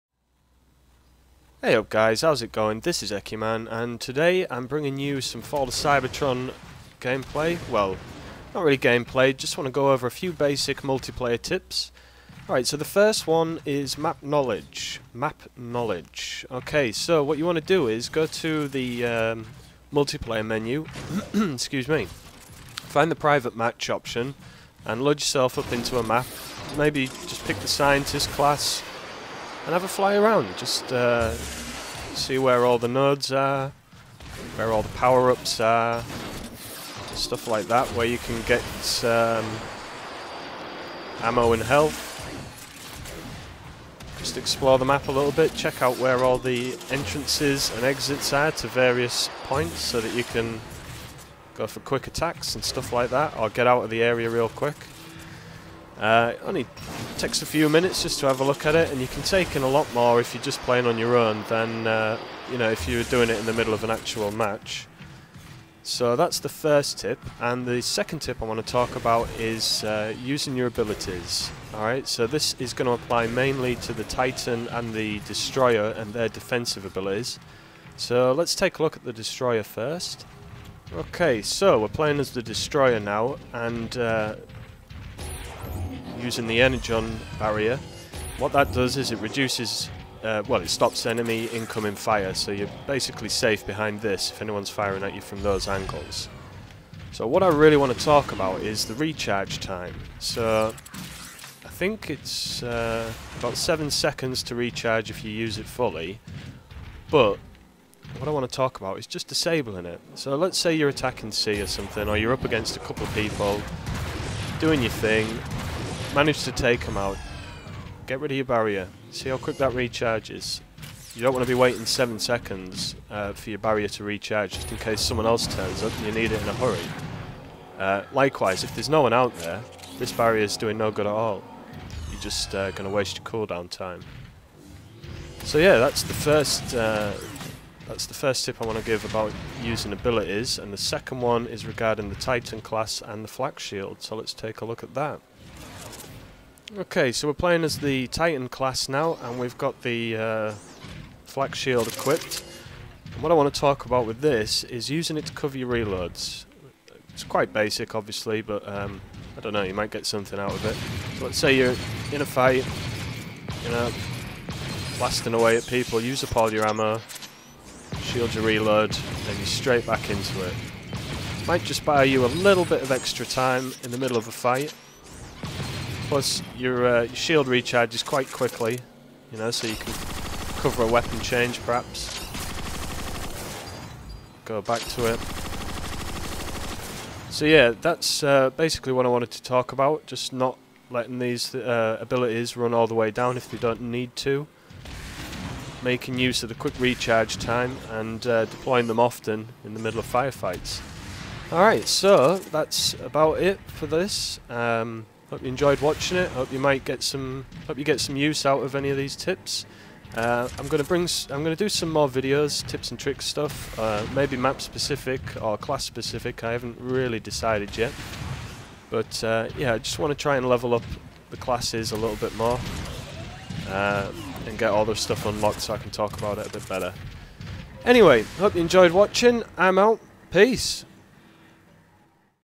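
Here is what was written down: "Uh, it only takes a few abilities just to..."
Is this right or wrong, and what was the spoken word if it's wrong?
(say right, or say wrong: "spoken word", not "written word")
wrong: "minutes", not "abilities".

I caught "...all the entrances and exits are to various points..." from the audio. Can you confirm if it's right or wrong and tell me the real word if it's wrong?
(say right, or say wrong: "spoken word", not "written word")
right.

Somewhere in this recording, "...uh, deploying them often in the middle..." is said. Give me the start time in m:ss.
3:18.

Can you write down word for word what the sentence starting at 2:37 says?
It's quite basic, obviously, but um, I don't know, you might get something out of it.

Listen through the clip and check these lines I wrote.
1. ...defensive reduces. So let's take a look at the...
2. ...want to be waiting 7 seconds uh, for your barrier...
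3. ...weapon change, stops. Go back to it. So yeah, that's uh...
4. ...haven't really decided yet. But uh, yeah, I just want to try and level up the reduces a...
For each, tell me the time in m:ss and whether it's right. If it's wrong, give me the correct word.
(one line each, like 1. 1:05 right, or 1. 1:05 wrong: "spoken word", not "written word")
1. 1:16 wrong: "abilities", not "reduces"
2. 2:01 right
3. 3:00 wrong: "perhaps", not "stops"
4. 3:36 wrong: "classes", not "reduces".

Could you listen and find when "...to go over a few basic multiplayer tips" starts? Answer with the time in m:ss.
0:09.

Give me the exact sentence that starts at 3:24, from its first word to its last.
Um, Hope you enjoyed watching it.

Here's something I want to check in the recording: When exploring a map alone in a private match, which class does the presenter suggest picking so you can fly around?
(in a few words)
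Scientist.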